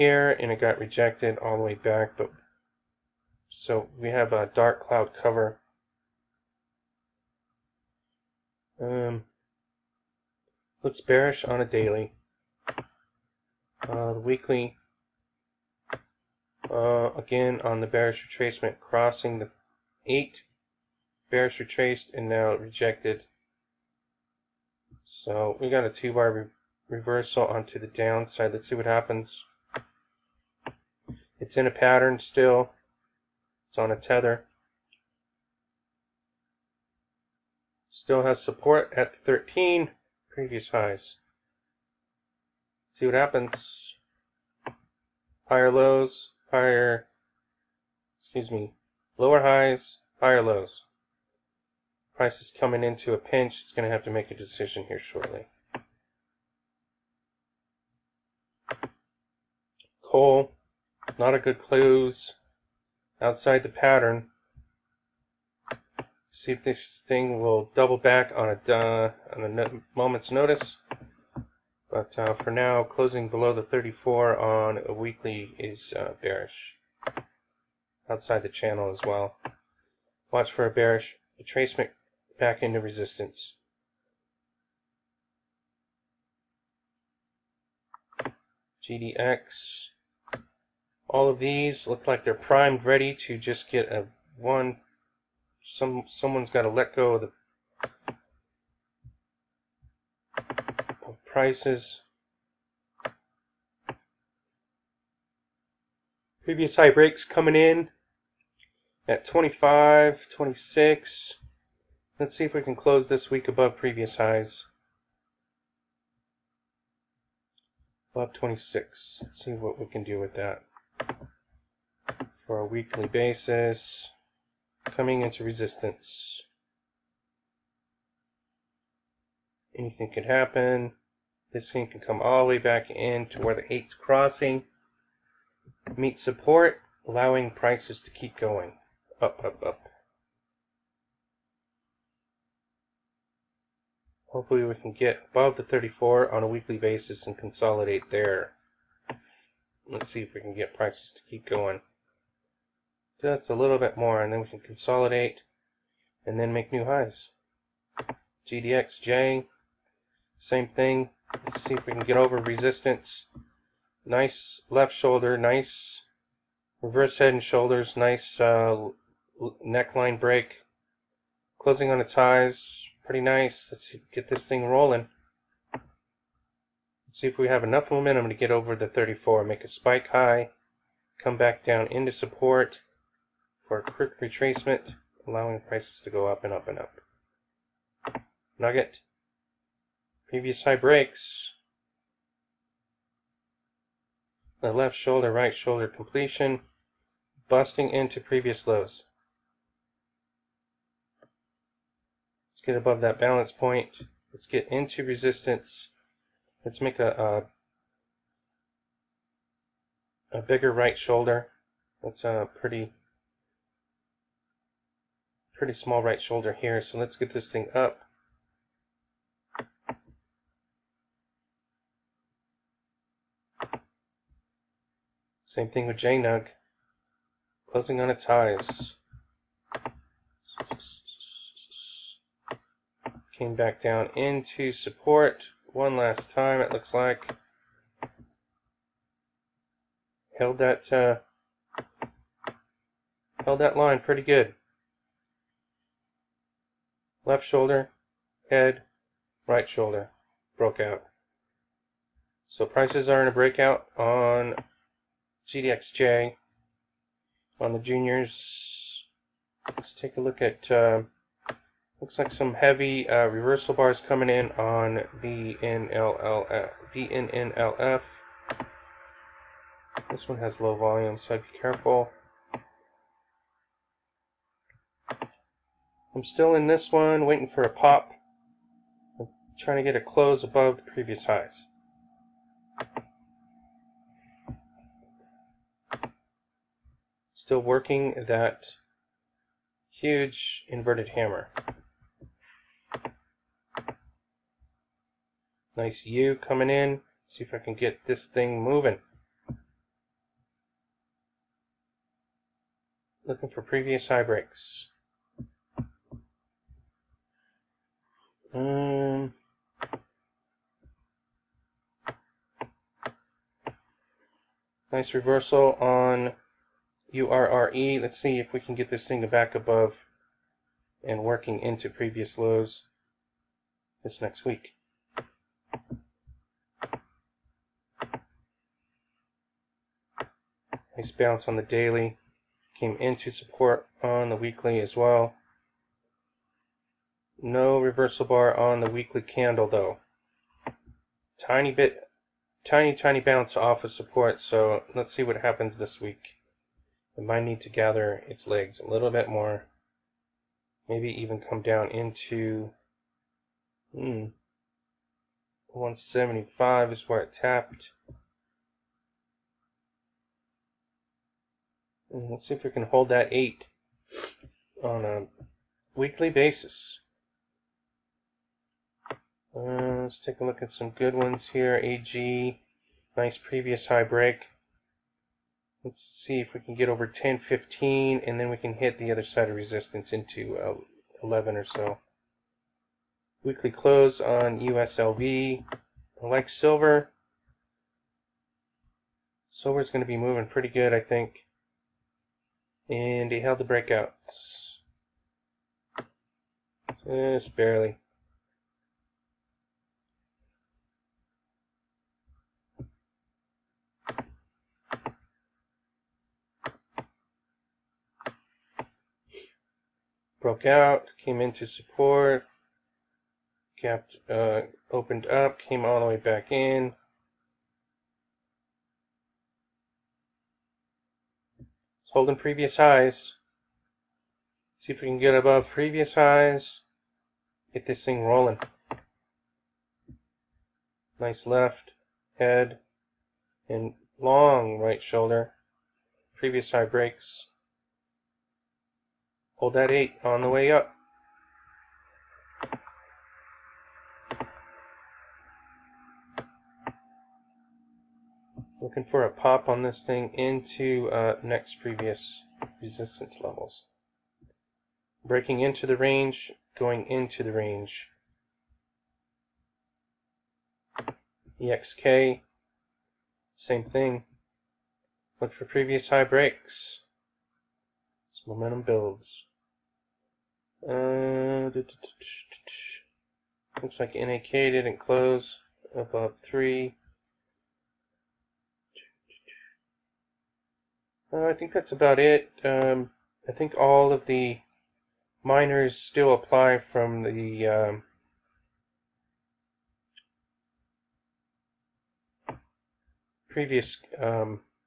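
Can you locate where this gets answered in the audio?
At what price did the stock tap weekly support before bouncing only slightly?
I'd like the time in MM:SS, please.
05:55.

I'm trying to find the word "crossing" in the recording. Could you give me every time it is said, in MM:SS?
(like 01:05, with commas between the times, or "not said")
00:18, 02:13.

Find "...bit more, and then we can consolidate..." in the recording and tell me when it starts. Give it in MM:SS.
02:33.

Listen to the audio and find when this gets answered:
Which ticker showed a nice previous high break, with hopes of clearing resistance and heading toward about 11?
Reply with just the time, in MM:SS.
06:11.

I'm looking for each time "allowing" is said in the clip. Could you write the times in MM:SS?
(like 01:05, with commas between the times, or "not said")
02:17, 03:05.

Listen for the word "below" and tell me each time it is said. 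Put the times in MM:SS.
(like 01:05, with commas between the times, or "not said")
01:13.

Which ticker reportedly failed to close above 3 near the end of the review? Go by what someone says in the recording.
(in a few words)
NAK.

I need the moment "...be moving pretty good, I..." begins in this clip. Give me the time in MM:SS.
06:30.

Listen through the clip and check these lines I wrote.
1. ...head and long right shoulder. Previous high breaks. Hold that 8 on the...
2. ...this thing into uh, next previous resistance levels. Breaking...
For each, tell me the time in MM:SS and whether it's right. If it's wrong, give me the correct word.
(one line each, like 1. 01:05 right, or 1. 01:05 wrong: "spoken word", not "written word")
1. 07:12 right
2. 07:29 right.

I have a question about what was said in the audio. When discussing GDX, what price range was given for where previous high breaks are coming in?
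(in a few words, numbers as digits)
25, 26.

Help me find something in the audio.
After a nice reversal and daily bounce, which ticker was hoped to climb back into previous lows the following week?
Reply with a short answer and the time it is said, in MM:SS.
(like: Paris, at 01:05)
URRE, at 05:17.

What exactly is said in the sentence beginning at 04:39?
I'm trying to get a close above the previous highs.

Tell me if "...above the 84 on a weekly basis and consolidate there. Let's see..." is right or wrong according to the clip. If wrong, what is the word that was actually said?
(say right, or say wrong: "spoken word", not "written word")
wrong: "34", not "84".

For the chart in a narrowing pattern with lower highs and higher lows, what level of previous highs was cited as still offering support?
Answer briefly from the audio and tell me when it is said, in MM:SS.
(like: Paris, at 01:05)
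13, at 00:39.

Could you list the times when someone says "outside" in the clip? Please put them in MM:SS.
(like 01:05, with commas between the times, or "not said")
01:03, 01:18.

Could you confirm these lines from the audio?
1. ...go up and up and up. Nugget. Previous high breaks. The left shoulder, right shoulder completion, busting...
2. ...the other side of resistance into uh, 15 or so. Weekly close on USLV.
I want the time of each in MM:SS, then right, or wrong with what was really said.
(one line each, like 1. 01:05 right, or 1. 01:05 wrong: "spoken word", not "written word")
1. 03:06 right
2. 06:18 wrong: "11", not "15".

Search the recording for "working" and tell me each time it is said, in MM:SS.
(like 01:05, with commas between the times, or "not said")
04:47, 05:21.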